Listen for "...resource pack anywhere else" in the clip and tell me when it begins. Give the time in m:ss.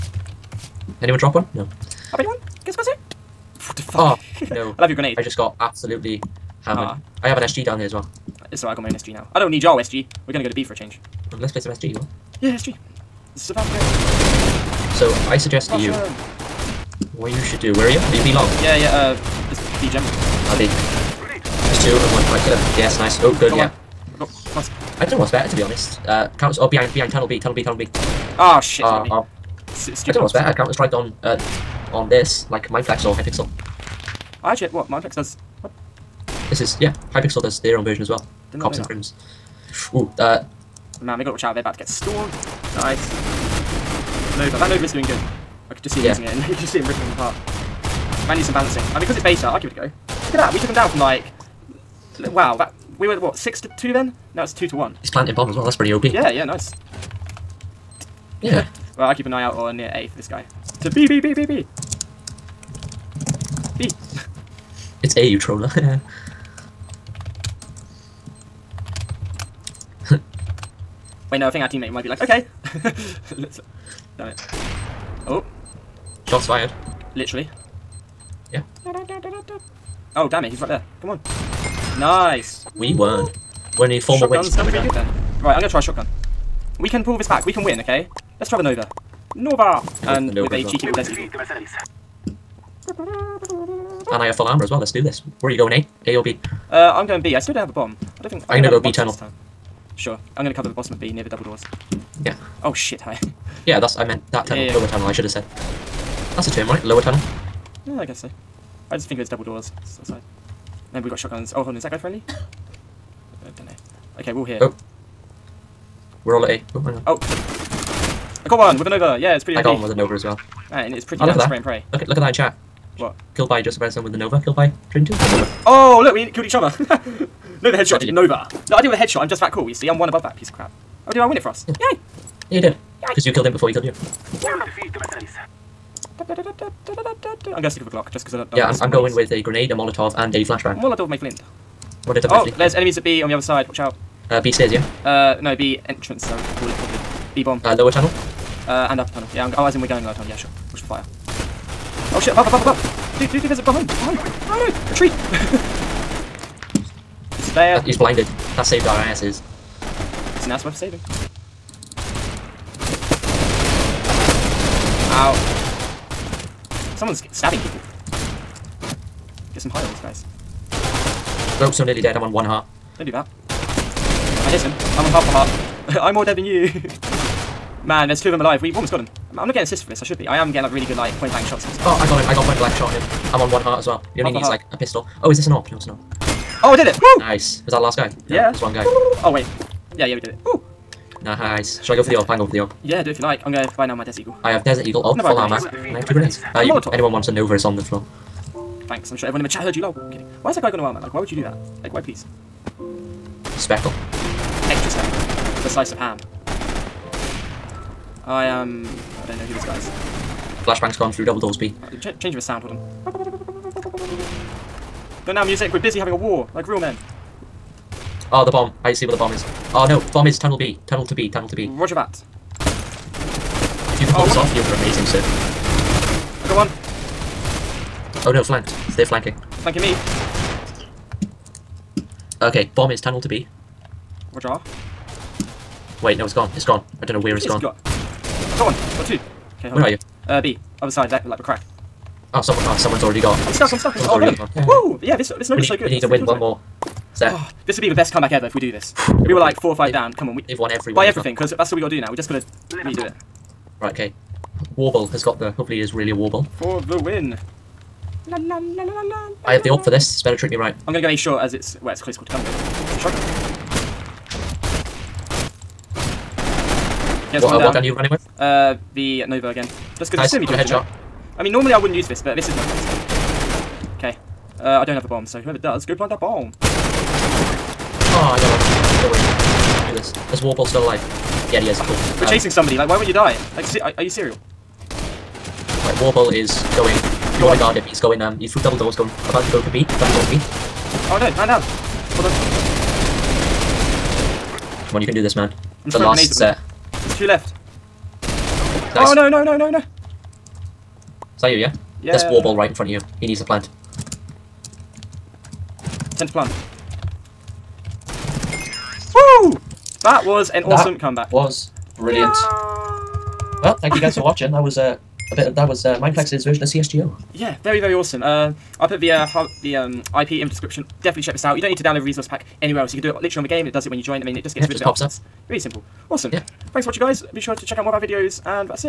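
5:22.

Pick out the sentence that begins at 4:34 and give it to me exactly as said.
Uh, I don't have a bomb, so whoever does, go plant that bomb.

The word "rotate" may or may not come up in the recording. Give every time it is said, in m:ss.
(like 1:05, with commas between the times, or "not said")
not said.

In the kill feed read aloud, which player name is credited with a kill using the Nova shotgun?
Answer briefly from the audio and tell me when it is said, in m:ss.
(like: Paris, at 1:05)
Joseph Reznor, at 2:03.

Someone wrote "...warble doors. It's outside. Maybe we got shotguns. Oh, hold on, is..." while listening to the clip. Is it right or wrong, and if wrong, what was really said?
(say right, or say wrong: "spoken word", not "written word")
wrong: "double", not "warble".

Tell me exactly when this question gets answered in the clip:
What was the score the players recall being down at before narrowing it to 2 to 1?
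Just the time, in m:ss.
0:53.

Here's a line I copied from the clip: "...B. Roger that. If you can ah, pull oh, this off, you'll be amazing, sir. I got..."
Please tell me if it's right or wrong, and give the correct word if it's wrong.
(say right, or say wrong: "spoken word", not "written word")
right.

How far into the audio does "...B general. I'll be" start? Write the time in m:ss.
0:19.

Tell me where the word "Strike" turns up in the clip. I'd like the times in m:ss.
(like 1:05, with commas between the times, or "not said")
0:30.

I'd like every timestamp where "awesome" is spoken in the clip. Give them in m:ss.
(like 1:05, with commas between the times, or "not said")
5:10, 5:17, 5:26.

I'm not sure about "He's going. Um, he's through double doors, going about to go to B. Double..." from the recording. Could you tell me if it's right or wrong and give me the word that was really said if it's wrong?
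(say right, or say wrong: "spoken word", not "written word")
right.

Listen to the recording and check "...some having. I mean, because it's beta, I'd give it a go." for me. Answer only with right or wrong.
wrong.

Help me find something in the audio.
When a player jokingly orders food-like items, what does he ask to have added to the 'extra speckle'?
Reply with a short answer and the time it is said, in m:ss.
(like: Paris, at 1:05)
A slice of ham, at 3:25.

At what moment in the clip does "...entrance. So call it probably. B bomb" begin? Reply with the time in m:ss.
2:25.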